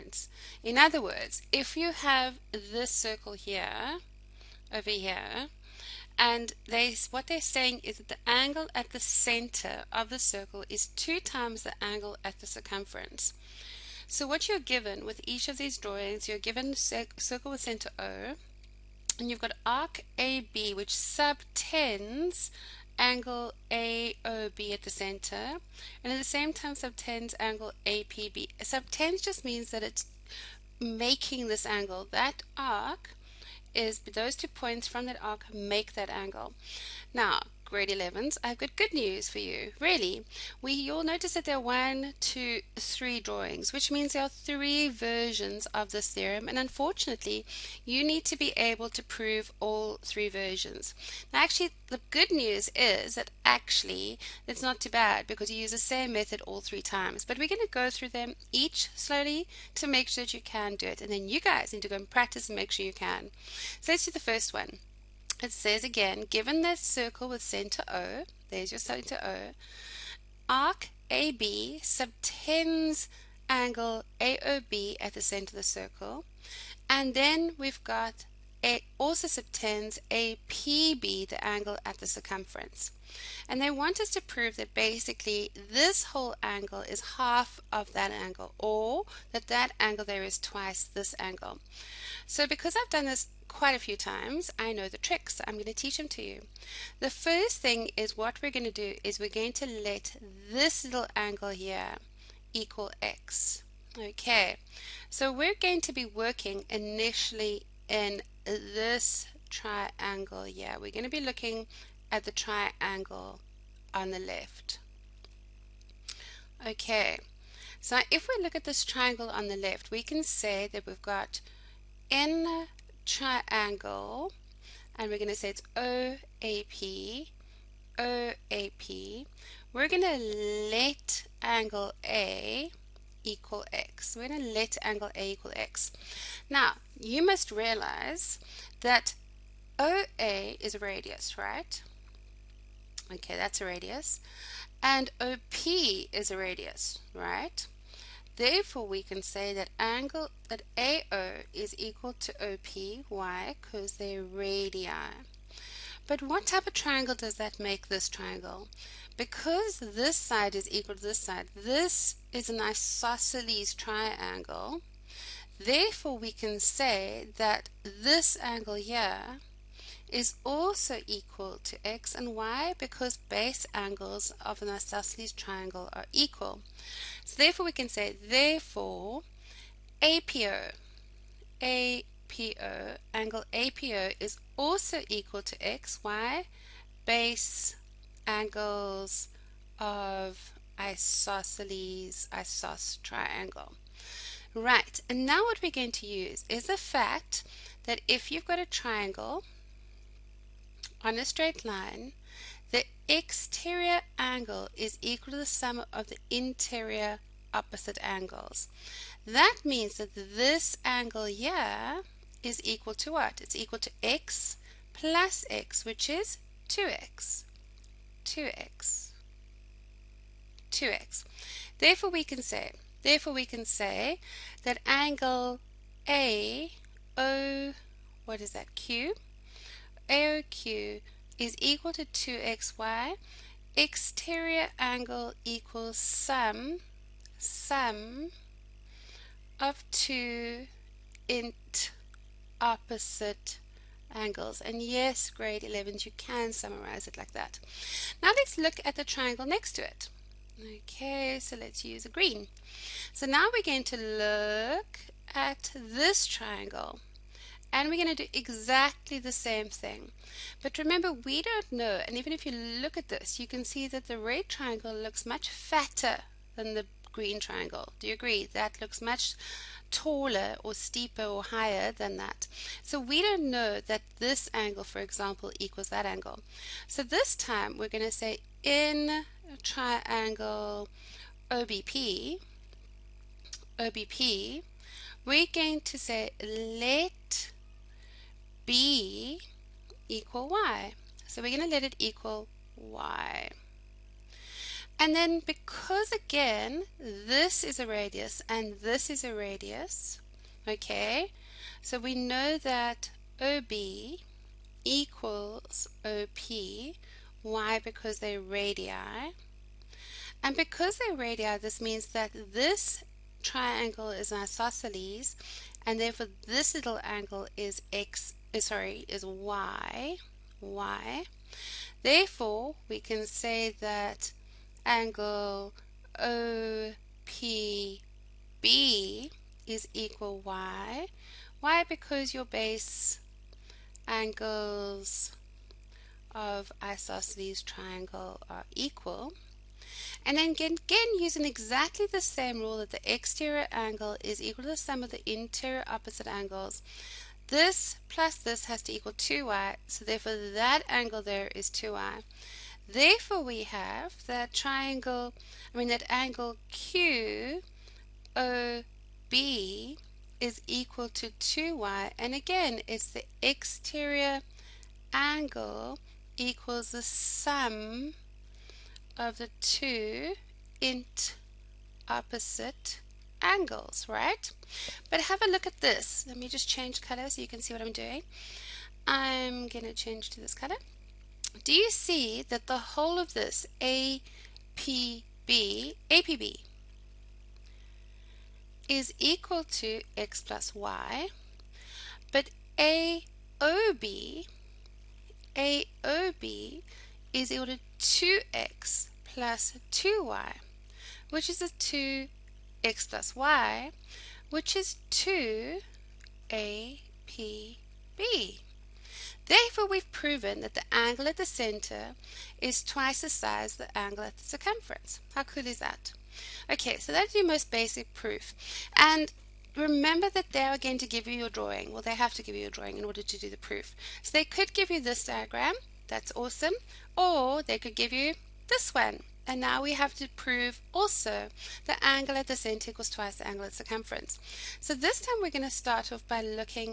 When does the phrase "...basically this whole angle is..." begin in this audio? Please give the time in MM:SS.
01:24.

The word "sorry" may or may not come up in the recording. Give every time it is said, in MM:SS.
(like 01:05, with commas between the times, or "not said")
05:18.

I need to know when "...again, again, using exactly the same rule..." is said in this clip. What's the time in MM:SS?
05:40.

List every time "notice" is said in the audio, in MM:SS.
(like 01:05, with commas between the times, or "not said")
00:41.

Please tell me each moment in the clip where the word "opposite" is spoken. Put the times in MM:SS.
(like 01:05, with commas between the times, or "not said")
03:27, 04:02, 05:45, 06:12.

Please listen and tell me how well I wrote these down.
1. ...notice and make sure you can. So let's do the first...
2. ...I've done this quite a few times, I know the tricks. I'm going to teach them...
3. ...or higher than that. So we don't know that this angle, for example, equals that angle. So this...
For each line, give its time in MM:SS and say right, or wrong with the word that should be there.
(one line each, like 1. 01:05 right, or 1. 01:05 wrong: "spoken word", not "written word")
1. 01:02 wrong: "practice", not "notice"
2. 01:32 right
3. 04:31 right.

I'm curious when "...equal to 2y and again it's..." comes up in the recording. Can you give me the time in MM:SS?
06:00.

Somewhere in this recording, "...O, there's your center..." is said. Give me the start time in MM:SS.
01:07.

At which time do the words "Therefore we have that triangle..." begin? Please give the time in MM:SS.
05:52.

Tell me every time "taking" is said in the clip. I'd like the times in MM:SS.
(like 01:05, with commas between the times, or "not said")
not said.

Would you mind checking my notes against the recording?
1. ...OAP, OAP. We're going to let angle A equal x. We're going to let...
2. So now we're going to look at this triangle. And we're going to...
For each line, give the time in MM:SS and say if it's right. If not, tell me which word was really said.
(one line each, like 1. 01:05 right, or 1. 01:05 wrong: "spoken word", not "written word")
1. 02:05 right
2. 04:13 right.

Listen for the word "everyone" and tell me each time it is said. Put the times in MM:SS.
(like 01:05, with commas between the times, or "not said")
not said.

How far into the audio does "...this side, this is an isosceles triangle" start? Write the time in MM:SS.
02:41.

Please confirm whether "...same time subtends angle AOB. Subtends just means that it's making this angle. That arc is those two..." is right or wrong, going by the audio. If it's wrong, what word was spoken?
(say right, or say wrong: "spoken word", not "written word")
wrong: "APB", not "AOB".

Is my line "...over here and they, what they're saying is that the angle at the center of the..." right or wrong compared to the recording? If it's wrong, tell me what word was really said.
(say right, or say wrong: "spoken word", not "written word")
right.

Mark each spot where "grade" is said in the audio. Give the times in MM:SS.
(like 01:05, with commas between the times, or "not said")
00:37, 04:05.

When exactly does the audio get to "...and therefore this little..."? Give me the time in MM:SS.
05:15.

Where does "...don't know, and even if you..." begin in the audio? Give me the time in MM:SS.
04:21.